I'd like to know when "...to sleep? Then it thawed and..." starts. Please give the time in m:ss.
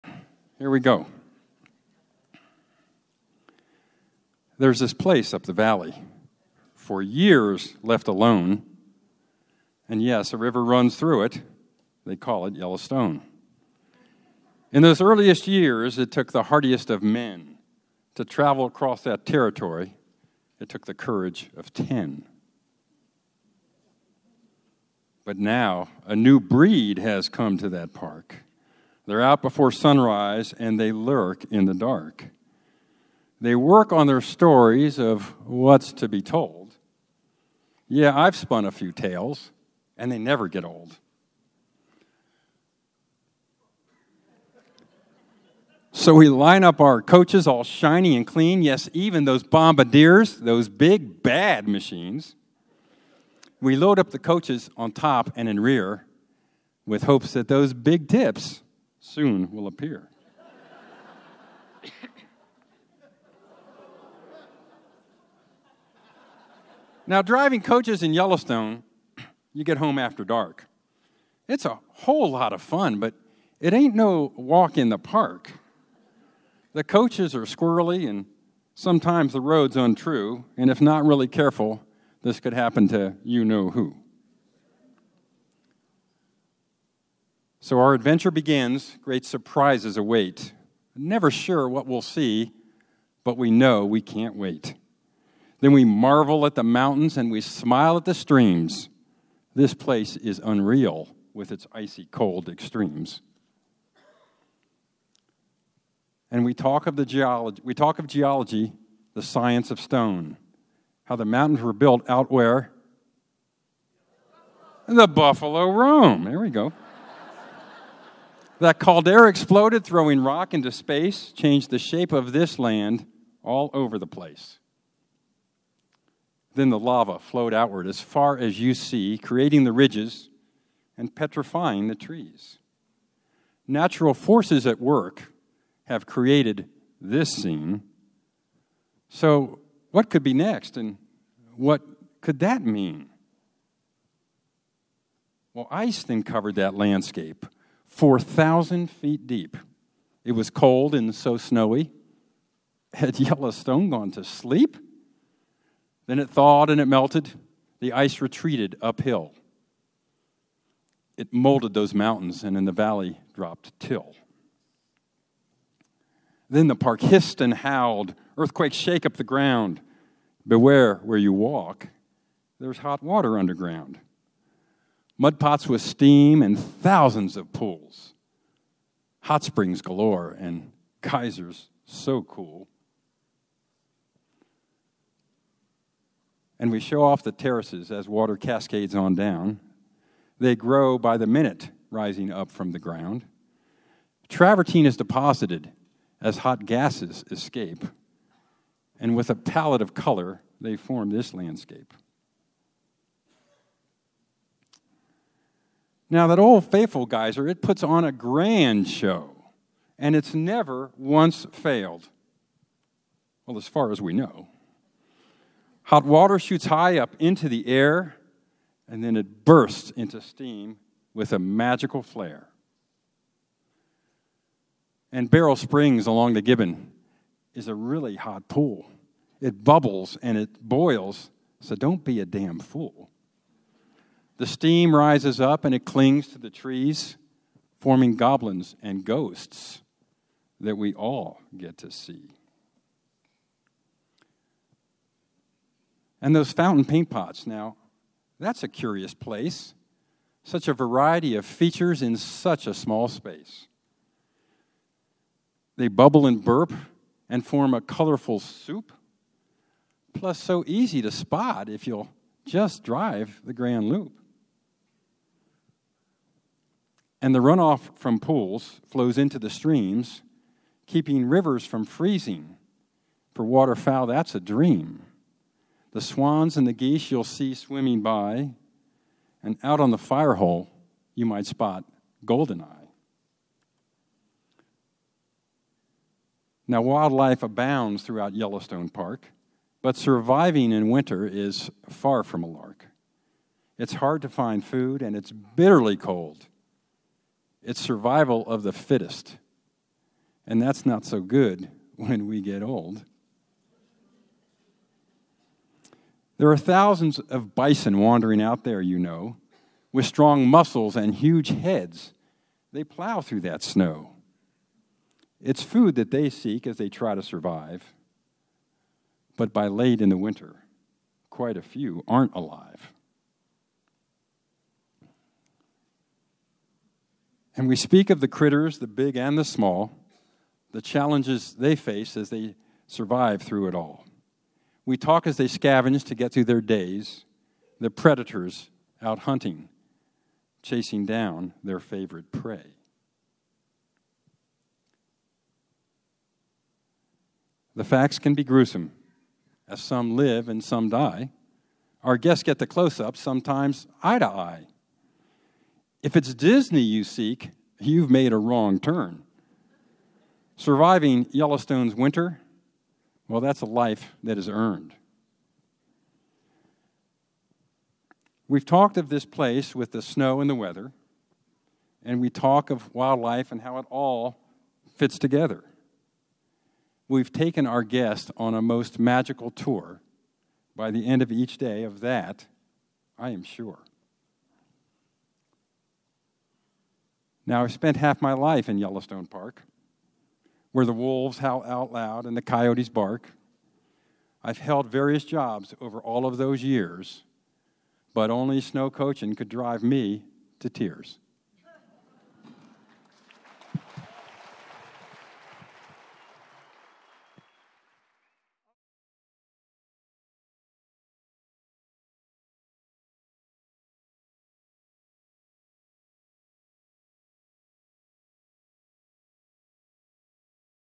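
2:34.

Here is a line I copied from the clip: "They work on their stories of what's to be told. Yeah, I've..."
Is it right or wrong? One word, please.
right.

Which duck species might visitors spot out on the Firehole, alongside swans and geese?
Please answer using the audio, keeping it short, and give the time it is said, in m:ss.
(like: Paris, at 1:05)
goldeneye, at 4:42.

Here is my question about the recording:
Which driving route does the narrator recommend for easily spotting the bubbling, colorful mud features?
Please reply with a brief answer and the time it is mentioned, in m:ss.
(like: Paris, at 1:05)
Grand Loop, at 4:23.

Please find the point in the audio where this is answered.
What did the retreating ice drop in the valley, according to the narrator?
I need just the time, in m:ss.
2:42.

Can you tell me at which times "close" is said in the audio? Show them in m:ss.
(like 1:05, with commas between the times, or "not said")
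5:52.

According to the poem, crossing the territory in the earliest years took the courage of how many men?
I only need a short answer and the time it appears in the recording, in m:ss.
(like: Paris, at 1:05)
10, at 0:20.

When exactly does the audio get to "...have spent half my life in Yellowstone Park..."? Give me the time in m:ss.
6:27.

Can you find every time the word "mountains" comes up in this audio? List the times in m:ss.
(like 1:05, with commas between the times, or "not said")
1:36, 1:51, 2:41.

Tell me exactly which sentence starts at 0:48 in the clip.
Yes, even those bombardiers, those big bad machines.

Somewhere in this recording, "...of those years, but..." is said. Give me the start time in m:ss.
6:36.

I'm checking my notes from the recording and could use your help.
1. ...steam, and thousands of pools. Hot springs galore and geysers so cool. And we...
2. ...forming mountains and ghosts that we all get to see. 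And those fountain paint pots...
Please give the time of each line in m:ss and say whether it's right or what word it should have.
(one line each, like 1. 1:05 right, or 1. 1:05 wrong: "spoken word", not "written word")
1. 2:55 right
2. 3:57 wrong: "goblins", not "mountains".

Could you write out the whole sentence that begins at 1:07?
now, driving coaches in Yellowstone, you get home after dark.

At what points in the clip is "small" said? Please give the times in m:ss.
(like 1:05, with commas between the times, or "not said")
4:12, 5:29.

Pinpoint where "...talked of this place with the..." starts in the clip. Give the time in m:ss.
6:08.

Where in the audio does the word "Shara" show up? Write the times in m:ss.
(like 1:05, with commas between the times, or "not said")
not said.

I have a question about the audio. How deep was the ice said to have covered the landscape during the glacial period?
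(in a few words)
4,000 feet.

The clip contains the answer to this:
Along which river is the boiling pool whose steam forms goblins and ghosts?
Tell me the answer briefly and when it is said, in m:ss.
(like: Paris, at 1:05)
Gibbon, at 3:46.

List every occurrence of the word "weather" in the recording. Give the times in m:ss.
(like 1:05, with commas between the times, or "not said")
6:10.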